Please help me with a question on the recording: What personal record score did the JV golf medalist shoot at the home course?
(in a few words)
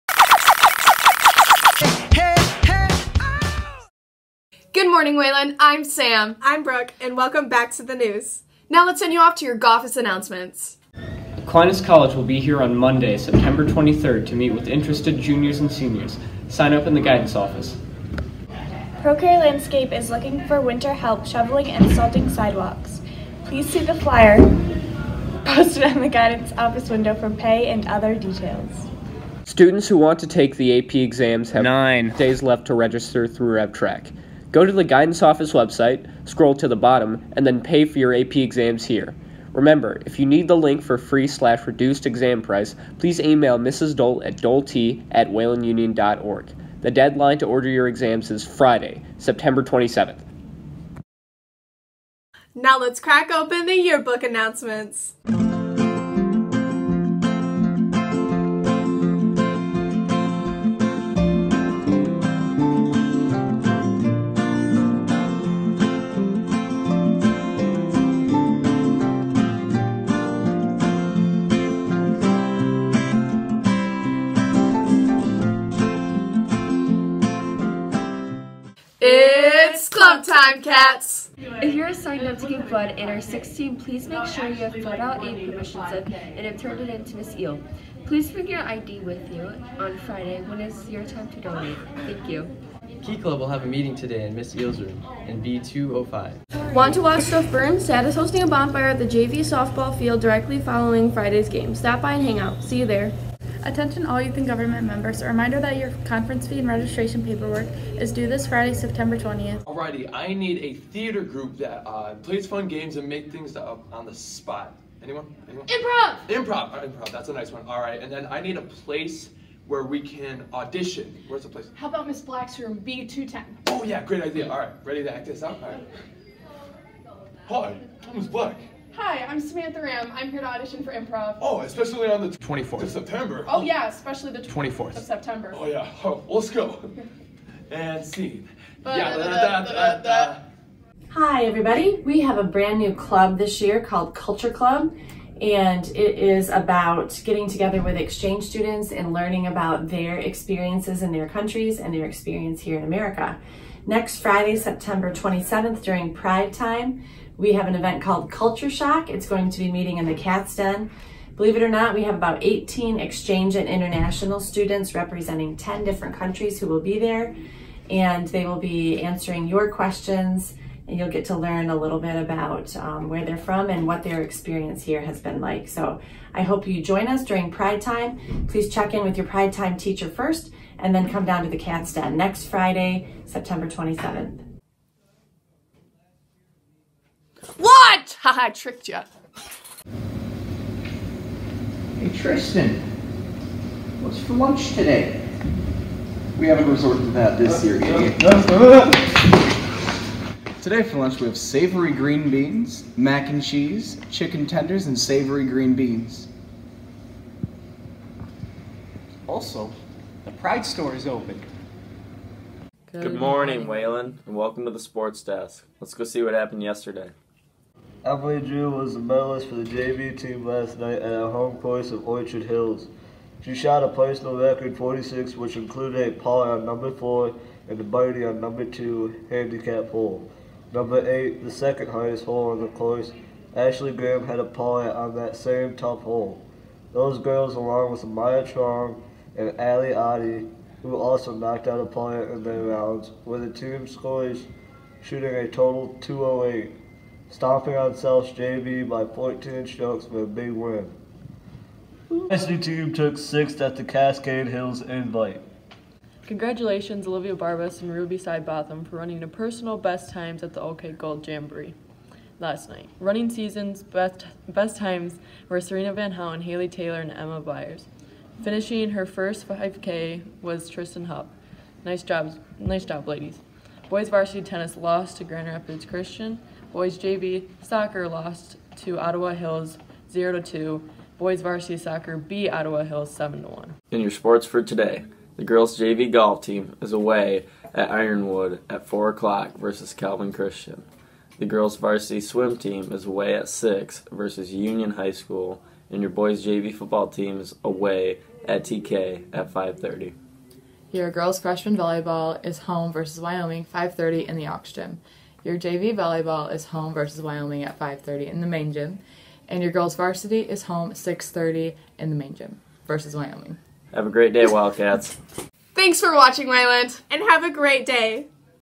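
46.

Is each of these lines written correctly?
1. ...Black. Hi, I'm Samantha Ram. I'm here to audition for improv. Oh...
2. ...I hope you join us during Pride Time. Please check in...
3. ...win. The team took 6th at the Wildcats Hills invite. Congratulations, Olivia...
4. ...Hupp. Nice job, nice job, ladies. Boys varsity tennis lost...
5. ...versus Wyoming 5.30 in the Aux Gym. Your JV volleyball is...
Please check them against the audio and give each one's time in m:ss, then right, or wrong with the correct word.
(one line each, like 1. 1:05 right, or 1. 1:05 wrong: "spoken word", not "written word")
1. 2:08 right
2. 2:56 right
3. 4:10 wrong: "Cascade", not "Wildcats"
4. 4:31 right
5. 5:02 right.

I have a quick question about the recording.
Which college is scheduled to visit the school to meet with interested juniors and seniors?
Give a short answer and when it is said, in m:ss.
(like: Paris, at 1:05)
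Aquinas College, at 0:11.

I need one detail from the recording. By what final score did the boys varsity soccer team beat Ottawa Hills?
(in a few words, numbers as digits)
7-1.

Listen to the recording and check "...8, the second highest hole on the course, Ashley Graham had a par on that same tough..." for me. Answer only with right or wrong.
right.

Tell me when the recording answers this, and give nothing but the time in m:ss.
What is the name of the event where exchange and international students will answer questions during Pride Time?
2:38.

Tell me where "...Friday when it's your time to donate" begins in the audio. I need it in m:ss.
1:29.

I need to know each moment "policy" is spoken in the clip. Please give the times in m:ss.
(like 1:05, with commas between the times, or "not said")
not said.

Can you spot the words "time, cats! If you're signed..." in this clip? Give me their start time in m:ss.
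1:20.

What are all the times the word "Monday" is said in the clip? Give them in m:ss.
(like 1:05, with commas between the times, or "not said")
0:12.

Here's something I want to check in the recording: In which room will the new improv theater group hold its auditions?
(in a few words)
B210.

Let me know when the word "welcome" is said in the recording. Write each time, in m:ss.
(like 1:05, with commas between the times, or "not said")
0:07, 3:34.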